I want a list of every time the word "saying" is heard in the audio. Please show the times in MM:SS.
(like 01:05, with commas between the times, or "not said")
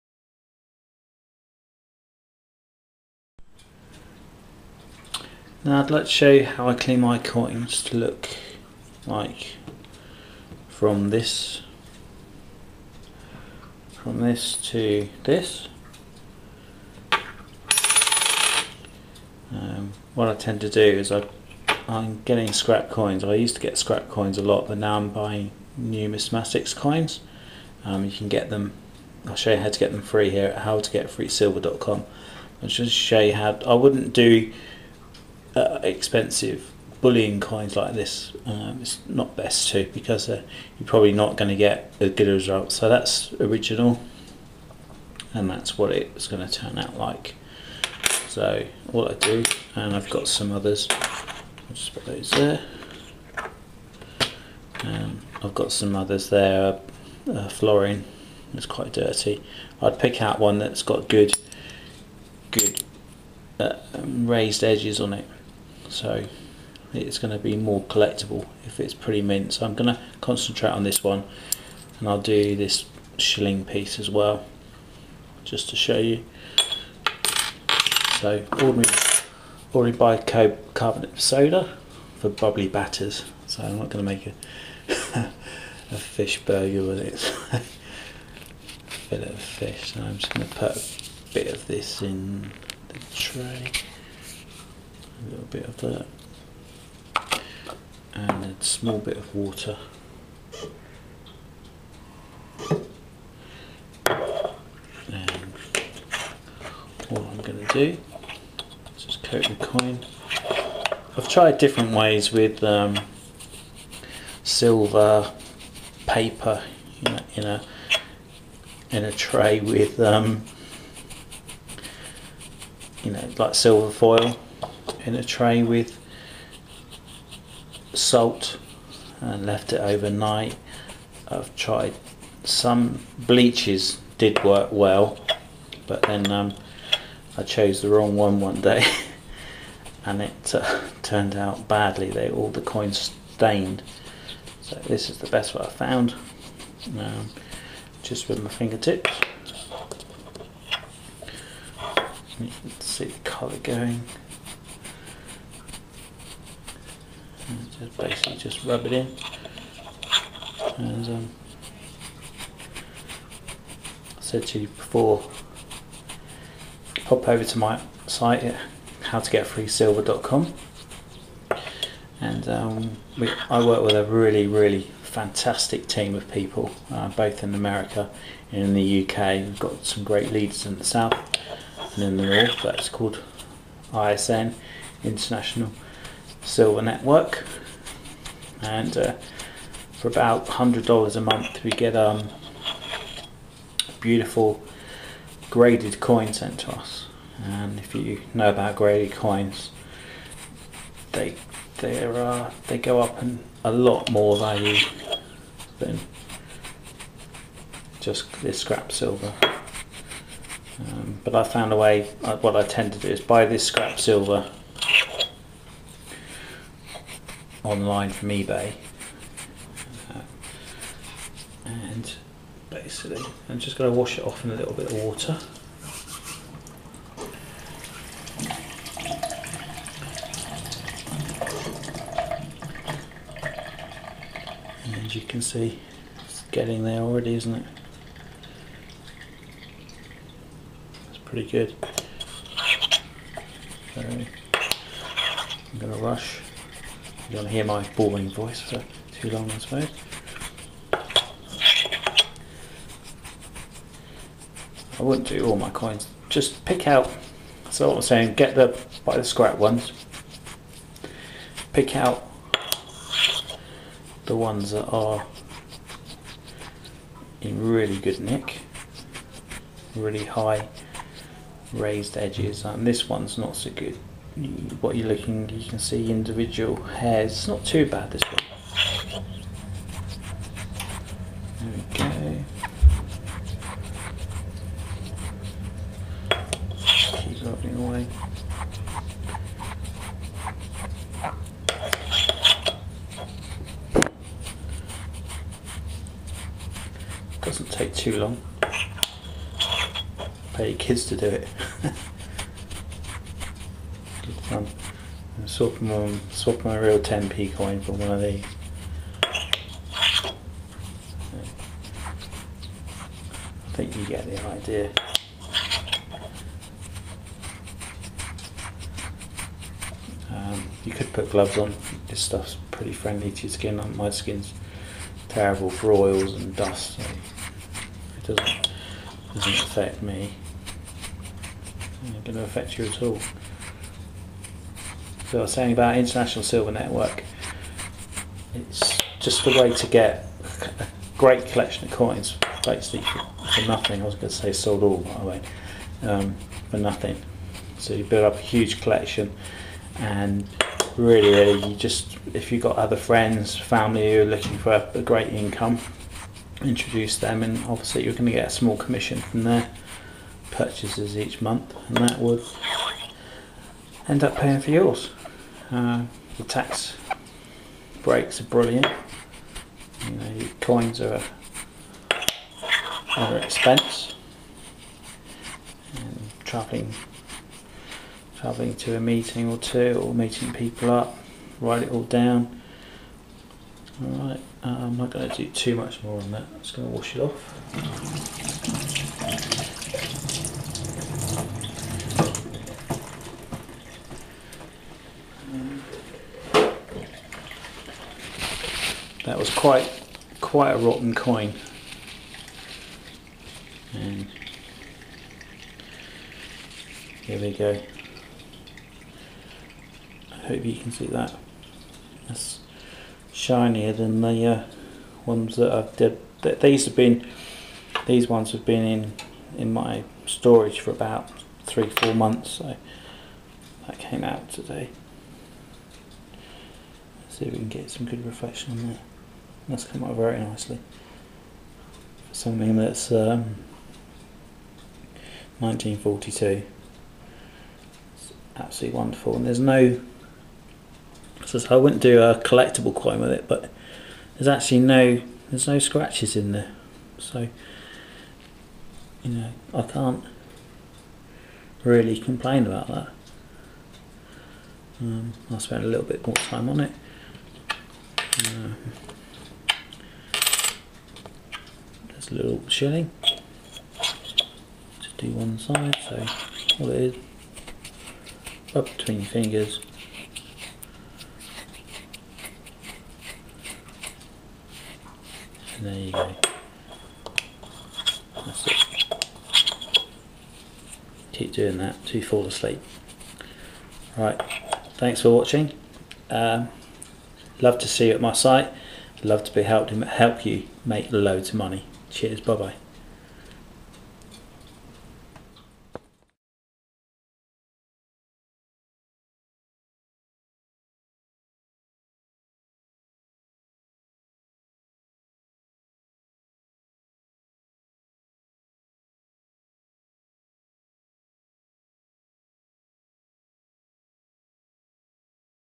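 04:18, 05:35.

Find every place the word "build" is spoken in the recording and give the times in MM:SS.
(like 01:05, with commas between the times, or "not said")
05:48.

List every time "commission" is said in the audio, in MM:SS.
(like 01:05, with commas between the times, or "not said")
05:58.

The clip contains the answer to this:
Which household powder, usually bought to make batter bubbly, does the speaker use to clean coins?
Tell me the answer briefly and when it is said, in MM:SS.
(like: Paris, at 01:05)
bicarbonate soda, at 01:19.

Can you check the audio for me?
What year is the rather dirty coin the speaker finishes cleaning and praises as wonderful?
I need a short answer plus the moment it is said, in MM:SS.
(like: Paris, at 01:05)
1942, at 07:15.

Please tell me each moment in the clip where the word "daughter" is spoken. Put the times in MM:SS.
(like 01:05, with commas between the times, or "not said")
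not said.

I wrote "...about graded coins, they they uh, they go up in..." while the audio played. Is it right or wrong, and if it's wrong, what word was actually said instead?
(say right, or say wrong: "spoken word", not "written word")
right.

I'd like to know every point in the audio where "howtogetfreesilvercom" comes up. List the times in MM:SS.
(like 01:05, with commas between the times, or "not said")
00:30, 02:49.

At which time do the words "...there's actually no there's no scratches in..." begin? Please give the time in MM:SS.
07:24.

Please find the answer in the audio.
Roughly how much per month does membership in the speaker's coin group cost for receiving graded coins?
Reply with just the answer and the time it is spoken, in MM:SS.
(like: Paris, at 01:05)
$100, at 03:10.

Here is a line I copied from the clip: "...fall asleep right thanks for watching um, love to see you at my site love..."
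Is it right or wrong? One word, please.
right.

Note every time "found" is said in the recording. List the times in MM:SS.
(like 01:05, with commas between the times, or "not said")
02:25, 03:31.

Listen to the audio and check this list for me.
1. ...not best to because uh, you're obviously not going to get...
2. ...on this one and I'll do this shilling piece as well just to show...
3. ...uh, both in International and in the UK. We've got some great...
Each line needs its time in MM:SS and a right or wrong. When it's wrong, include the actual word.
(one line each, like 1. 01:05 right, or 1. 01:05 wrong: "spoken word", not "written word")
1. 00:39 wrong: "probably", not "obviously"
2. 01:10 right
3. 02:56 wrong: "America", not "International".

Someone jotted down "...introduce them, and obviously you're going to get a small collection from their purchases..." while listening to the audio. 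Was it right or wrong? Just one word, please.
wrong.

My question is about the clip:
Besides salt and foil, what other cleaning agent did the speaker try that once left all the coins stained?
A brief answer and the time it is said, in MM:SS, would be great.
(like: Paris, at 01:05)
bleaches, at 02:13.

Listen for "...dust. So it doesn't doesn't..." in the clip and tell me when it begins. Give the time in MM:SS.
05:26.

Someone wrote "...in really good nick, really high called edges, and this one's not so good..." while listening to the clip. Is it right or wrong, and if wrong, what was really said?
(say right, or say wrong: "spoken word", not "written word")
wrong: "raised", not "called".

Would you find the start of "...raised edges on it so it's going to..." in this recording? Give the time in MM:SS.
01:04.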